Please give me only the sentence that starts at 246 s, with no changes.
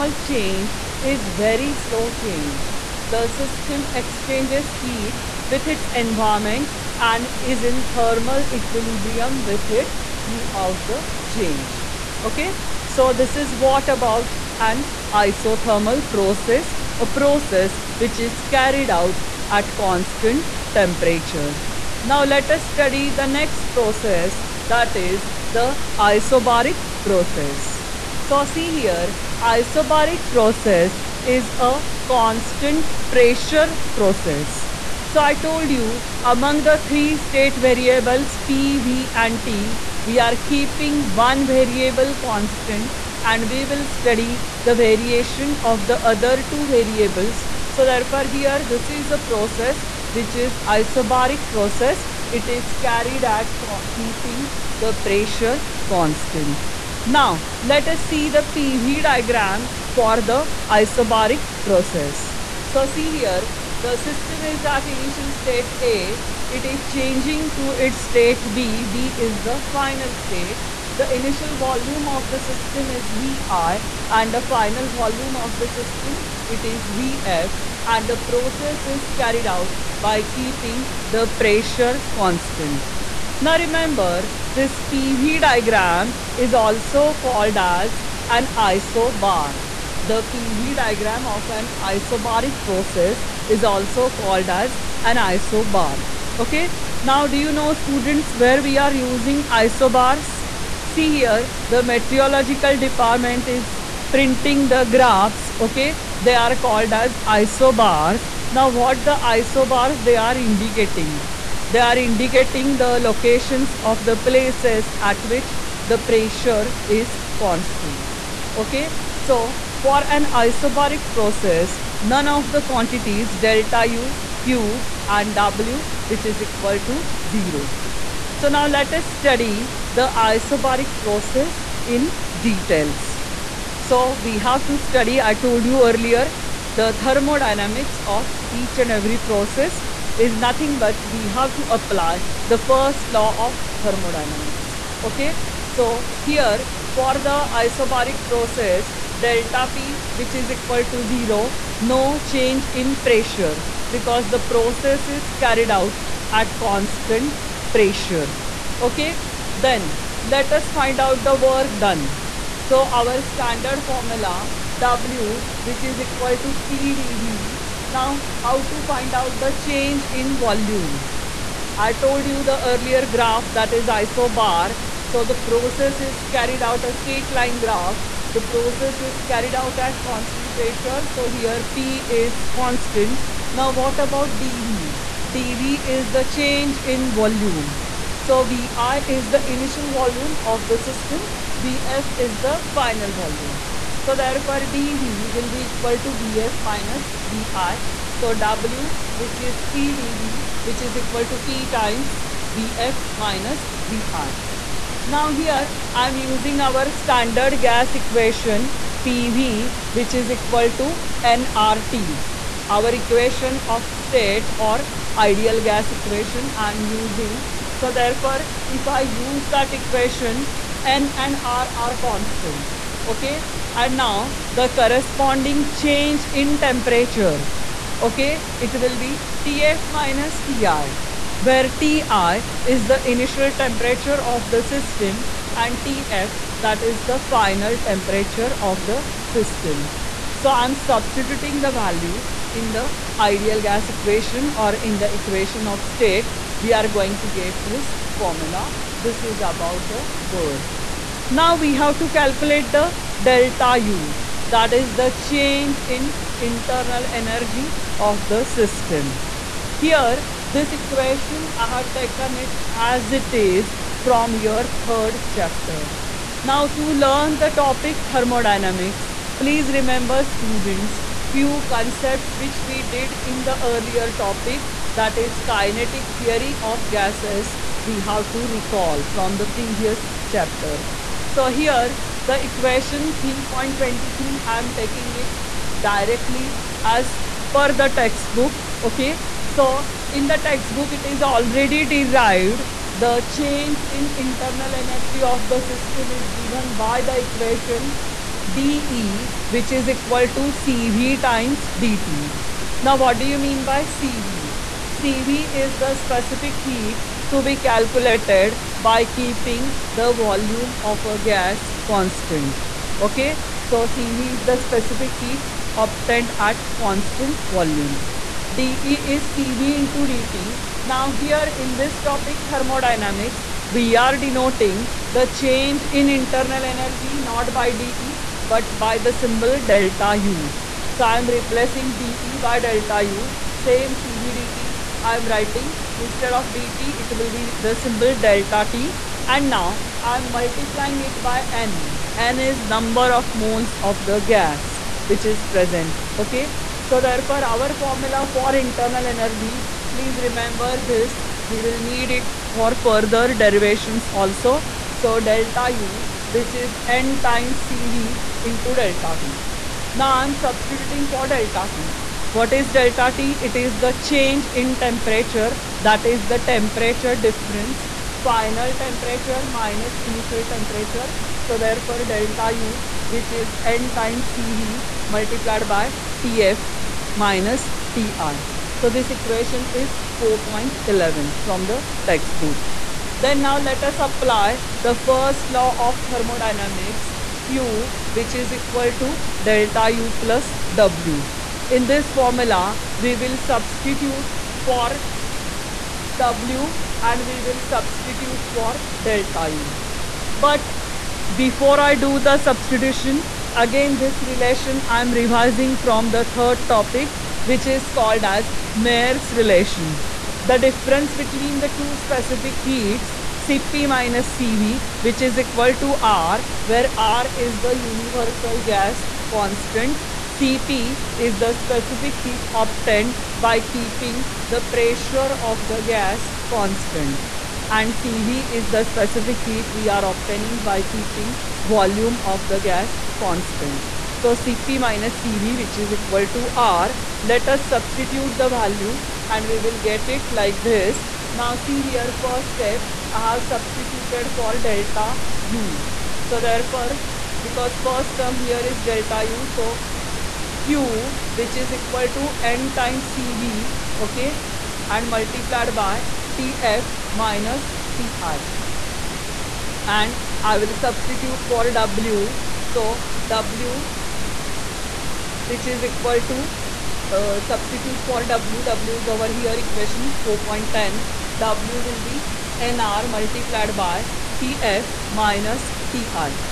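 We are going to get this formula.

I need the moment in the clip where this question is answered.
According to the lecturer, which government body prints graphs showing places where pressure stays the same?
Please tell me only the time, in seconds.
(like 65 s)
101 s.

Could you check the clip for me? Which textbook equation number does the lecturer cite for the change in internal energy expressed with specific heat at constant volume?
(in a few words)
3.23.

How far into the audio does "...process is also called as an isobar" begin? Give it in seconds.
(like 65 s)
92 s.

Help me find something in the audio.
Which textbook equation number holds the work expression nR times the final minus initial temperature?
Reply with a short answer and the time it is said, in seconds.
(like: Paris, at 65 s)
4.10, at 469 s.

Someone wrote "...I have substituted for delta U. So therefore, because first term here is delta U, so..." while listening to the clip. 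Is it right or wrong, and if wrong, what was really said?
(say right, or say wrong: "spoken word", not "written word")
right.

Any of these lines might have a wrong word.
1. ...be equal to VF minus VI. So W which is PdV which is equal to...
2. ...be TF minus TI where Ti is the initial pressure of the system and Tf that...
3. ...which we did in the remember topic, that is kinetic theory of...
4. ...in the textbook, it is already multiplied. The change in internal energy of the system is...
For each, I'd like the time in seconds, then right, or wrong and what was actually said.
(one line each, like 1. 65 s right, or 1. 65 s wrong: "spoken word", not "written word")
1. 195 s right
2. 229 s wrong: "temperature", not "pressure"
3. 272 s wrong: "earlier", not "remember"
4. 290 s wrong: "derived", not "multiplied".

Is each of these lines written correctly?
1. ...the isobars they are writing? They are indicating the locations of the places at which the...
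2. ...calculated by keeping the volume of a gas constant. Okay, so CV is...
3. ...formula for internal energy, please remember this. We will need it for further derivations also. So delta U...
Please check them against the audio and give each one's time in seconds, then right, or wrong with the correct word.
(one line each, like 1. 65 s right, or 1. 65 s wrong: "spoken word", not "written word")
1. 109 s wrong: "indicating", not "writing"
2. 307 s right
3. 347 s right.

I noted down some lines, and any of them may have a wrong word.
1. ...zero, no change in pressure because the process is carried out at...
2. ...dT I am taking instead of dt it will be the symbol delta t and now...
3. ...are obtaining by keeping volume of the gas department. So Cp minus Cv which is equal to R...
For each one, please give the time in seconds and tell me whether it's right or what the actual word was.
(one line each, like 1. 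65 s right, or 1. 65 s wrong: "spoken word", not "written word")
1. 151 s right
2. 334 s wrong: "writing", not "taking"
3. 429 s wrong: "constant", not "department".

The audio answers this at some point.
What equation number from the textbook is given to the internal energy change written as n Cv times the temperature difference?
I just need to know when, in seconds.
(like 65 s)
380 s.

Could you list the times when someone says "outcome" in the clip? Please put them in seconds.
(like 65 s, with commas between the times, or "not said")
not said.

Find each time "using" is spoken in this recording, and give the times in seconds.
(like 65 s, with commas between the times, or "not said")
98 s, 206 s, 216 s.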